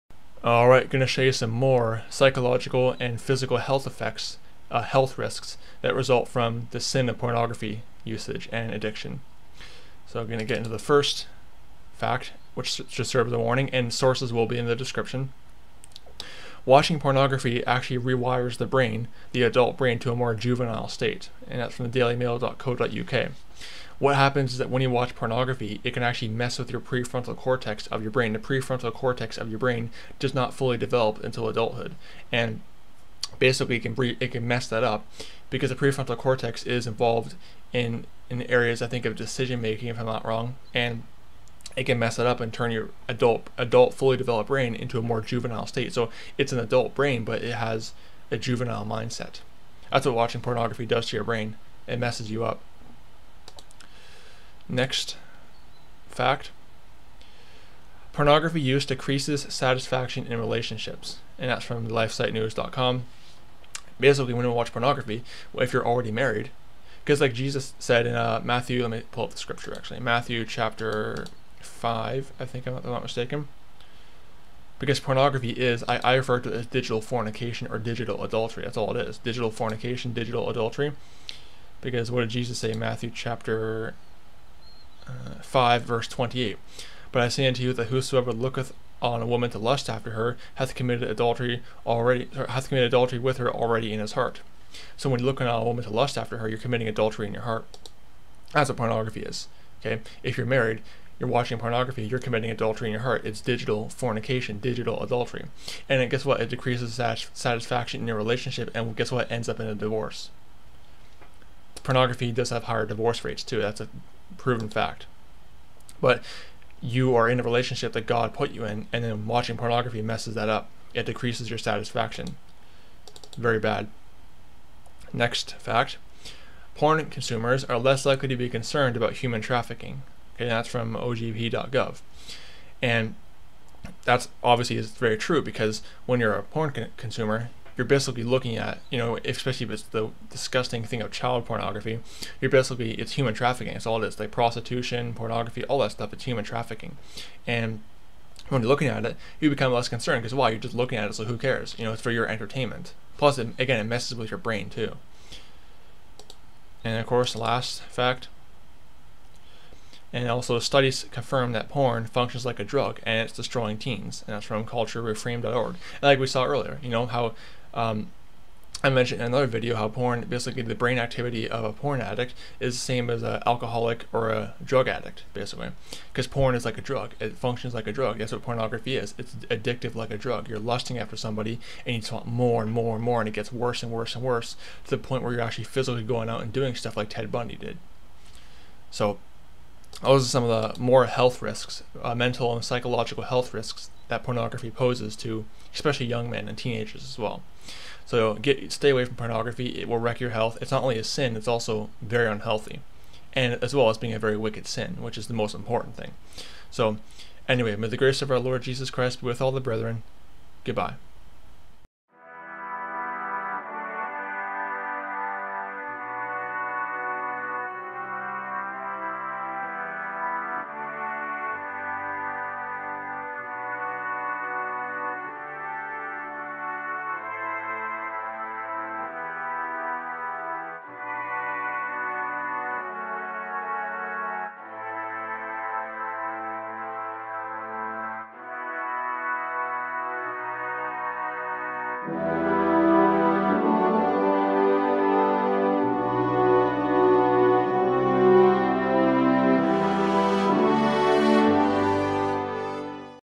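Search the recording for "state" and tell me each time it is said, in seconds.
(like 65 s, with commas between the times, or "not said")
20 s, 45 s.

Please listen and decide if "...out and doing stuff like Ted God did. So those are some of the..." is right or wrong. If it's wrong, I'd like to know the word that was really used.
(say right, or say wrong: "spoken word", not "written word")
wrong: "Bundy", not "God".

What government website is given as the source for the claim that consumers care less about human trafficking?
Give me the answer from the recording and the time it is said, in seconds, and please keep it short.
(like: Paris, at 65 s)
ojp.gov, at 130 s.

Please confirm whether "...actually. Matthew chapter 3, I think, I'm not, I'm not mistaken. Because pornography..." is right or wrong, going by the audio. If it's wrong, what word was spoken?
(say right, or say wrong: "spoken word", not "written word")
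wrong: "5", not "3".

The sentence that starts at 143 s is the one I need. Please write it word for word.
It's all this, like prostitution, pornography, all that stuff.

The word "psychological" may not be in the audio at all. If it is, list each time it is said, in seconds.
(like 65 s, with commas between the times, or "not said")
2 s, 192 s.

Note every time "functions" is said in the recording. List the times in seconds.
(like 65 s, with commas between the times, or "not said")
162 s, 177 s.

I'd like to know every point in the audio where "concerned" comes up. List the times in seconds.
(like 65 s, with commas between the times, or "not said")
128 s, 149 s.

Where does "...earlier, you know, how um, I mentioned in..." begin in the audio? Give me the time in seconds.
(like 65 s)
166 s.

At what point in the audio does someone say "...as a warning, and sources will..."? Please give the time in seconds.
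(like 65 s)
13 s.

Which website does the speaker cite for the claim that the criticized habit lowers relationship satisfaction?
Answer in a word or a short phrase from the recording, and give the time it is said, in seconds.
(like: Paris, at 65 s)
lifesitenews.com, at 61 s.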